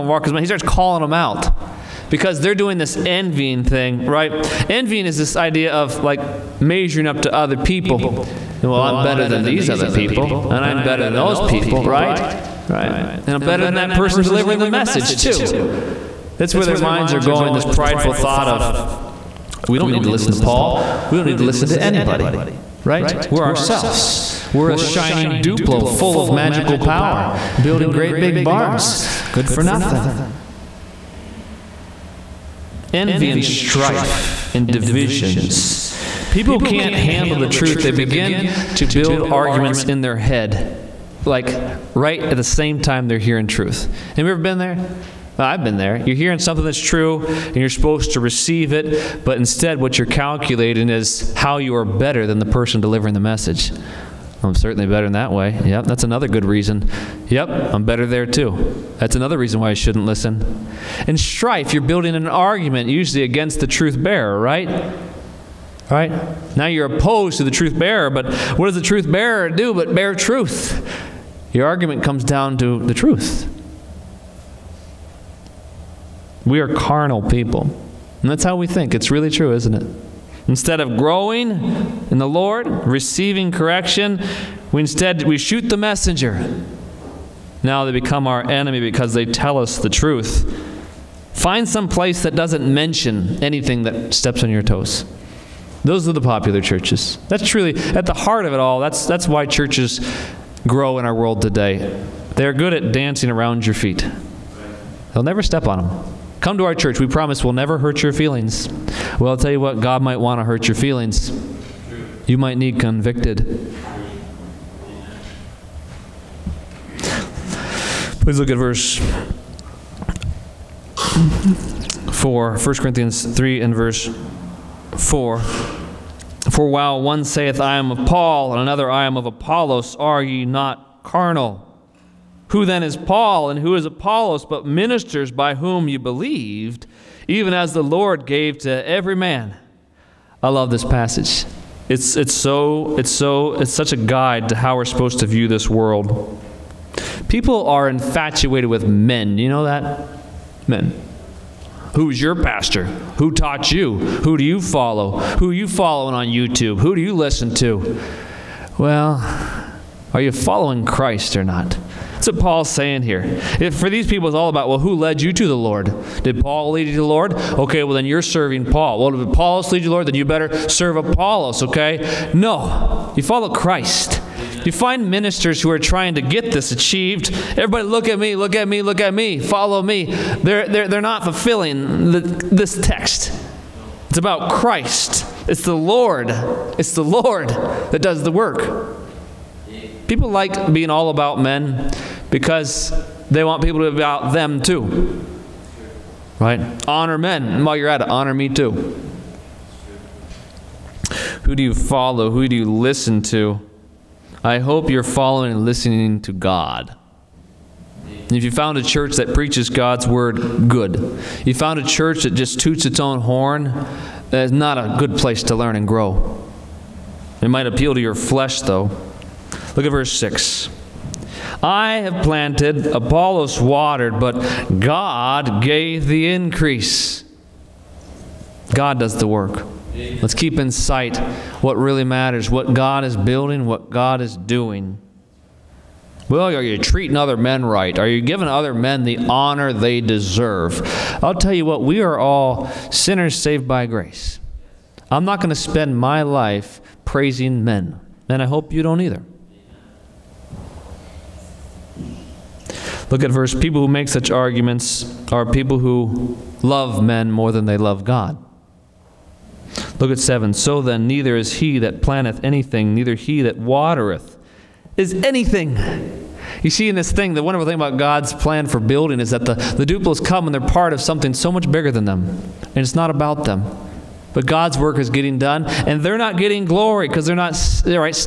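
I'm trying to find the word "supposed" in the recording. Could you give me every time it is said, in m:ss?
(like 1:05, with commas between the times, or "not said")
0:47, 2:24.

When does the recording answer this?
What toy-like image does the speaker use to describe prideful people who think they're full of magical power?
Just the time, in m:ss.
0:24.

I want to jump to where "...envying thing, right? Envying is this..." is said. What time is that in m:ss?
0:02.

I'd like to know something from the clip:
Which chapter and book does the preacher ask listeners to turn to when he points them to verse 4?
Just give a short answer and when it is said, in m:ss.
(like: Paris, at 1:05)
1 Corinthians 3, at 2:02.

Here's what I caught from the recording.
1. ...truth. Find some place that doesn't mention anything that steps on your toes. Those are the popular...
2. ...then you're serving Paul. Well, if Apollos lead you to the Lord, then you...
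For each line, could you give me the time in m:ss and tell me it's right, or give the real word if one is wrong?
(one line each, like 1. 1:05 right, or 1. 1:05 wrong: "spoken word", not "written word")
1. 1:29 right
2. 2:47 right.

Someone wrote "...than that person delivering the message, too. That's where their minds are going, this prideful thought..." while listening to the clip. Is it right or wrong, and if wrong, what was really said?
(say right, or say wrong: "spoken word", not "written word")
right.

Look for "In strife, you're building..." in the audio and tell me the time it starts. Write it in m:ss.
1:01.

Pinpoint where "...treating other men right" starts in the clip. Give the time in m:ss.
3:56.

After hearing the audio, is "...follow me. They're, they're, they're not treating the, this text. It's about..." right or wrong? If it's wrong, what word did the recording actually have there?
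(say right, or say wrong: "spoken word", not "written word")
wrong: "fulfilling", not "treating".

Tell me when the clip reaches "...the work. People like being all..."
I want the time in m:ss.
3:08.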